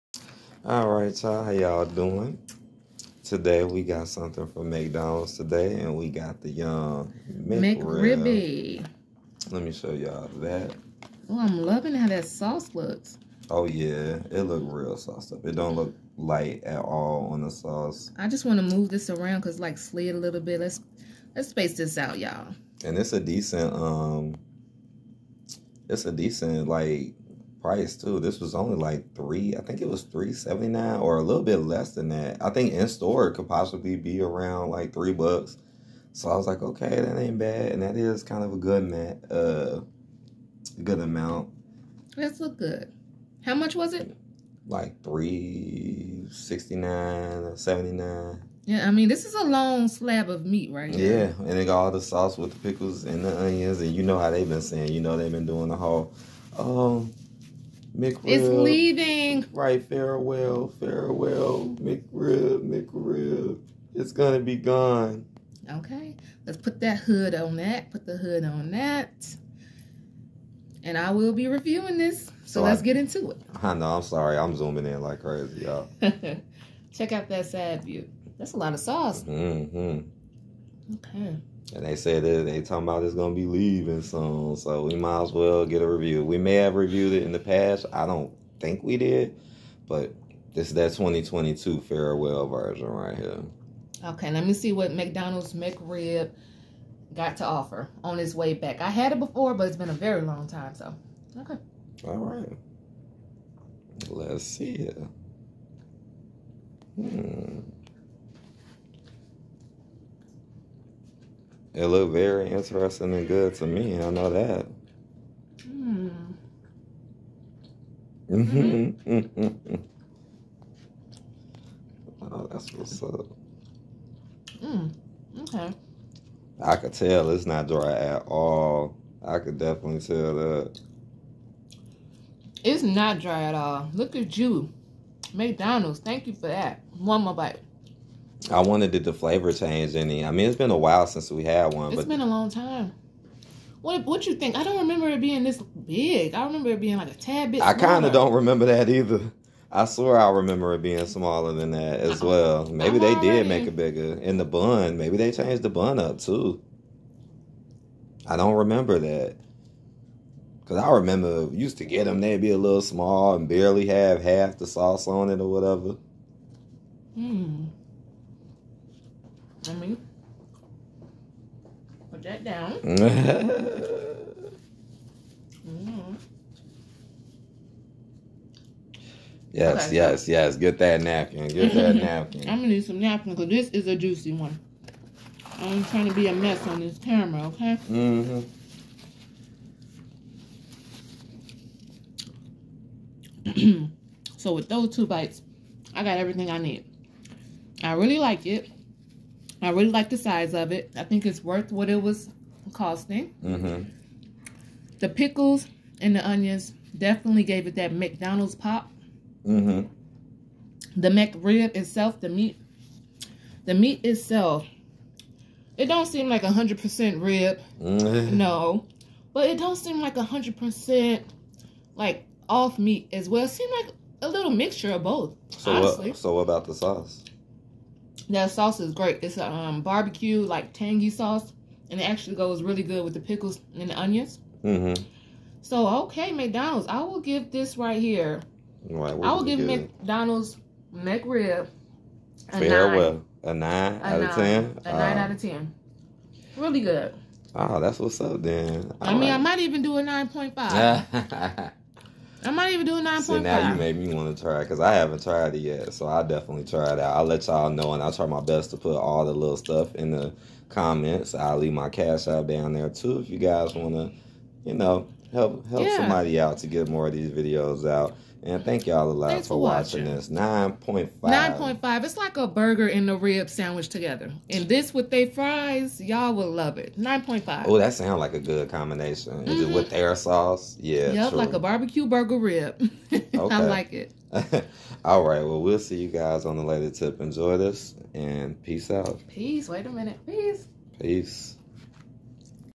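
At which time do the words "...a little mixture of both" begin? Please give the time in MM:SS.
03:44.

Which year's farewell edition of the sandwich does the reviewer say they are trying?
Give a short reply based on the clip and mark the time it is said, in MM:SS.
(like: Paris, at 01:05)
2022, at 01:30.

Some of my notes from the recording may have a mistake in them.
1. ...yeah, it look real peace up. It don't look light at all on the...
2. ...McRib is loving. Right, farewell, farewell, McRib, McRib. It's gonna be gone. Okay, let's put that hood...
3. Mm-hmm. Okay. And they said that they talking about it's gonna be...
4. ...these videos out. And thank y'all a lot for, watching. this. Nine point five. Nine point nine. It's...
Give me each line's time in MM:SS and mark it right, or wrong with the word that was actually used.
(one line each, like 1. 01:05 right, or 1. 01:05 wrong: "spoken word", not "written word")
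1. 00:13 wrong: "sauce", not "peace"
2. 00:57 wrong: "leaving", not "loving"
3. 01:19 right
4. 04:27 wrong: "five", not "nine".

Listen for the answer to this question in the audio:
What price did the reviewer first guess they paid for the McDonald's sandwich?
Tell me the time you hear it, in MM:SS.
00:30.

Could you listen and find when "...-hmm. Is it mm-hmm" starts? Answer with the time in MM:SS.
04:39.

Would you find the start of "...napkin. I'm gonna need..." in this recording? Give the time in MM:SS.
03:01.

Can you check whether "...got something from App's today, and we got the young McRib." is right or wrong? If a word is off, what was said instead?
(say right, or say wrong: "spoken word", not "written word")
wrong: "McDonald", not "App".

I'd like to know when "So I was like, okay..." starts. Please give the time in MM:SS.
00:36.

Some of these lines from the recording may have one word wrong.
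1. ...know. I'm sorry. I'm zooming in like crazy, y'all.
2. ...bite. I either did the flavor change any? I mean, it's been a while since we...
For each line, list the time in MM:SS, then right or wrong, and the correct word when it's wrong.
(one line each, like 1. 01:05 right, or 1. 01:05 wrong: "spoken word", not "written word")
1. 01:13 right
2. 02:17 wrong: "wonder", not "either".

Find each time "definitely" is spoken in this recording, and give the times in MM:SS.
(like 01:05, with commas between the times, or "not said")
02:09, 03:26, 04:16.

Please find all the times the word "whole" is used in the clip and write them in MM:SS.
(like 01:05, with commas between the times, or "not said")
00:55.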